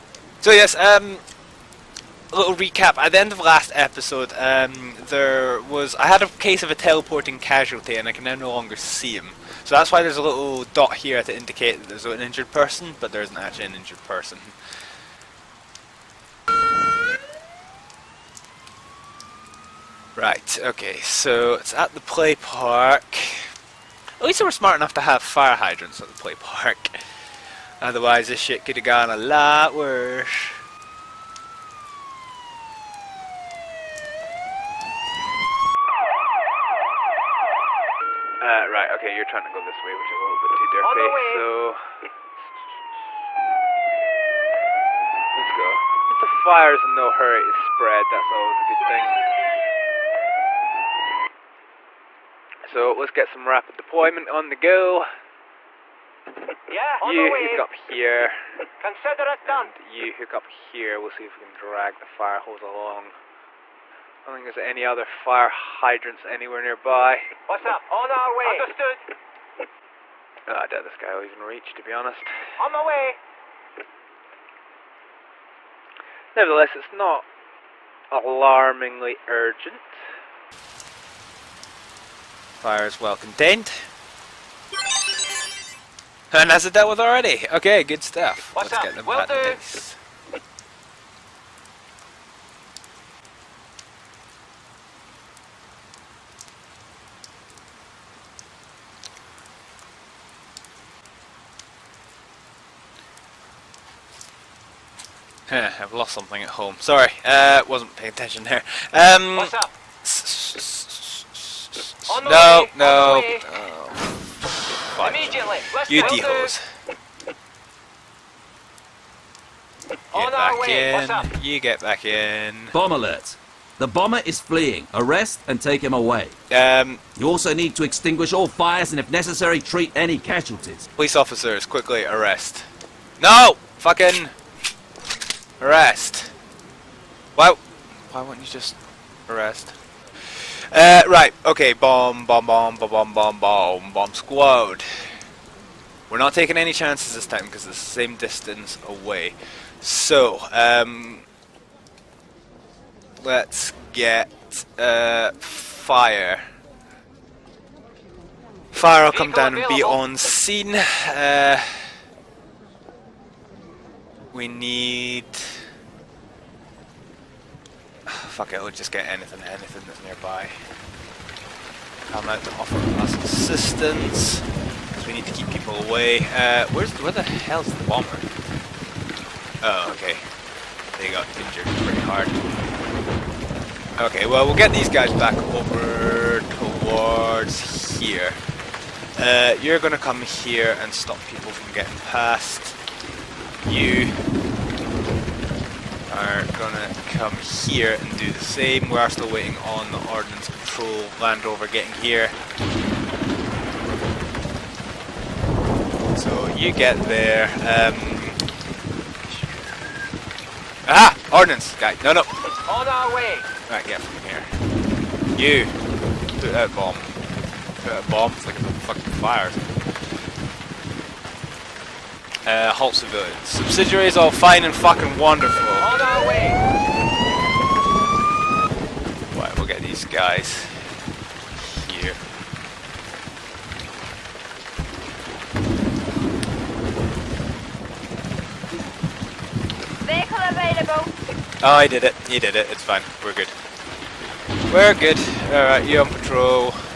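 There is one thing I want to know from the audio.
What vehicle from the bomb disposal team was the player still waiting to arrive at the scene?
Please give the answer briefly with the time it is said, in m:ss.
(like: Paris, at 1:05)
Ordnance Control Land Rover, at 3:20.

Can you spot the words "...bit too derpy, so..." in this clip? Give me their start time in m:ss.
0:40.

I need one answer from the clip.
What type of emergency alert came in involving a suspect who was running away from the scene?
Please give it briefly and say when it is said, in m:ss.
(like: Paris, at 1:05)
Bomb alert, at 2:02.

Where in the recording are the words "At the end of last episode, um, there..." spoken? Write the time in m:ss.
0:02.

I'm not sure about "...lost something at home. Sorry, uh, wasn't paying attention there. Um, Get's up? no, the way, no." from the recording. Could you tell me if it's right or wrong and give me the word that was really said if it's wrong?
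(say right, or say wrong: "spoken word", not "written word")
wrong: "What", not "Get".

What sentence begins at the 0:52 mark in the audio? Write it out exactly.
So, let's get some rapid deployment on the go.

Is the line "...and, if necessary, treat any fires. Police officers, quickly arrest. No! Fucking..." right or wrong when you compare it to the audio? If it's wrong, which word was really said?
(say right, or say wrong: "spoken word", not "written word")
wrong: "casualties", not "fires".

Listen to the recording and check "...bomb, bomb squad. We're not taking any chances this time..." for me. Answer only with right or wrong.
right.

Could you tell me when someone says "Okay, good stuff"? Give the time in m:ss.
1:27.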